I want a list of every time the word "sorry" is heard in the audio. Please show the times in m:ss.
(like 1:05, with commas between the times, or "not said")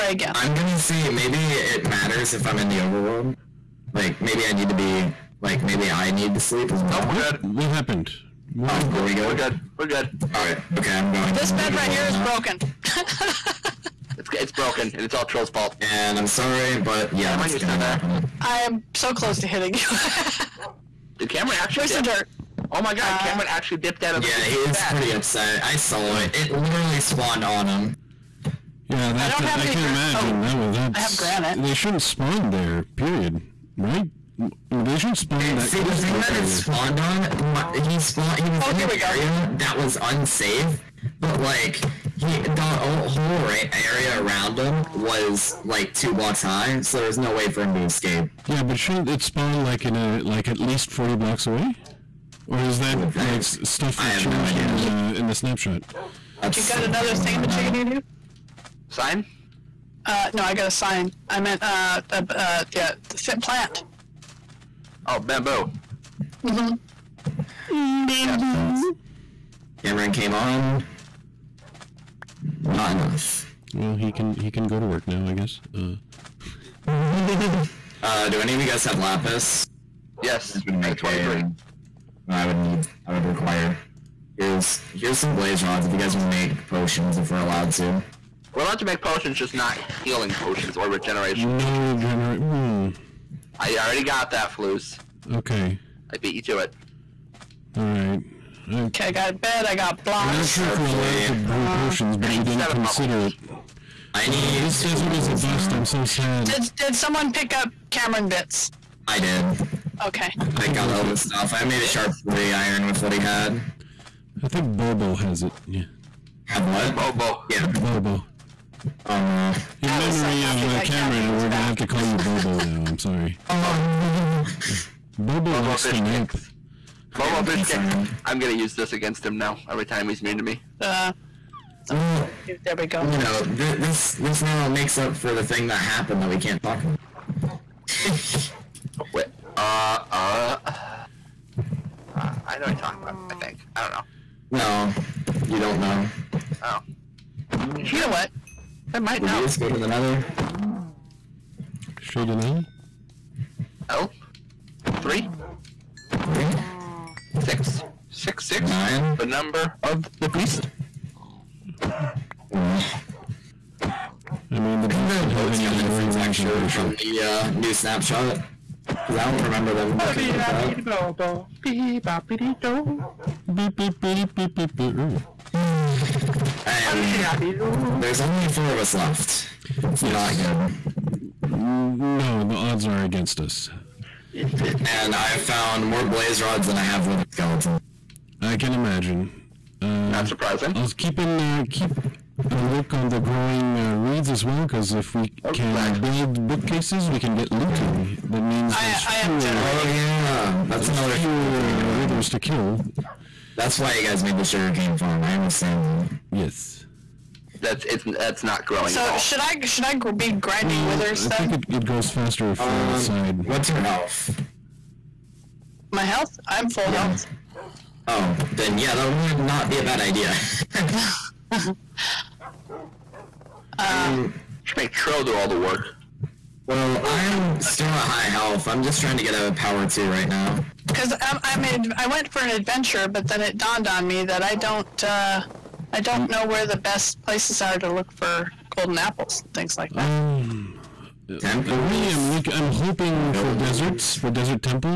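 0:16, 2:02.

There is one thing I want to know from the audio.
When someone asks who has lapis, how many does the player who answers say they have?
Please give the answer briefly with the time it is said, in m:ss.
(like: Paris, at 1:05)
23, at 1:20.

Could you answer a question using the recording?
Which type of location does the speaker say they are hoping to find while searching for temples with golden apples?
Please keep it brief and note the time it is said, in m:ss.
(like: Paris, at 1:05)
deserts, at 4:03.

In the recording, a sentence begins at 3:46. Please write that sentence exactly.
Well, I'm still at high health.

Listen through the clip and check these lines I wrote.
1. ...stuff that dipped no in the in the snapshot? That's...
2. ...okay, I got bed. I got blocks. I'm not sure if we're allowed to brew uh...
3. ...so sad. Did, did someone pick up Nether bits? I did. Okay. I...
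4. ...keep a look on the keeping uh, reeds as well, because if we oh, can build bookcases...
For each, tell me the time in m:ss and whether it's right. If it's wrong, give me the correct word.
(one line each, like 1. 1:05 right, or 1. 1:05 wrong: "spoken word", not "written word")
1. 0:53 wrong: "changed", not "dipped"
2. 1:38 right
3. 1:45 wrong: "Cameron", not "Nether"
4. 3:11 wrong: "growing", not "keeping".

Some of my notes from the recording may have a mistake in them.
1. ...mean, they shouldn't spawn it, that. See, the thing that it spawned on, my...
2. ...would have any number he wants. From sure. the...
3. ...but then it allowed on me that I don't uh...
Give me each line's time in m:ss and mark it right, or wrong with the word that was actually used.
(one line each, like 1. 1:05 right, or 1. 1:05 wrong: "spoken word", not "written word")
1. 0:34 right
2. 2:45 right
3. 3:53 wrong: "dawned", not "allowed".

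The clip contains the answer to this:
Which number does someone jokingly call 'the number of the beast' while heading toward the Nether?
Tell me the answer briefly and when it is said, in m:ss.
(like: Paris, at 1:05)
Nine, at 2:38.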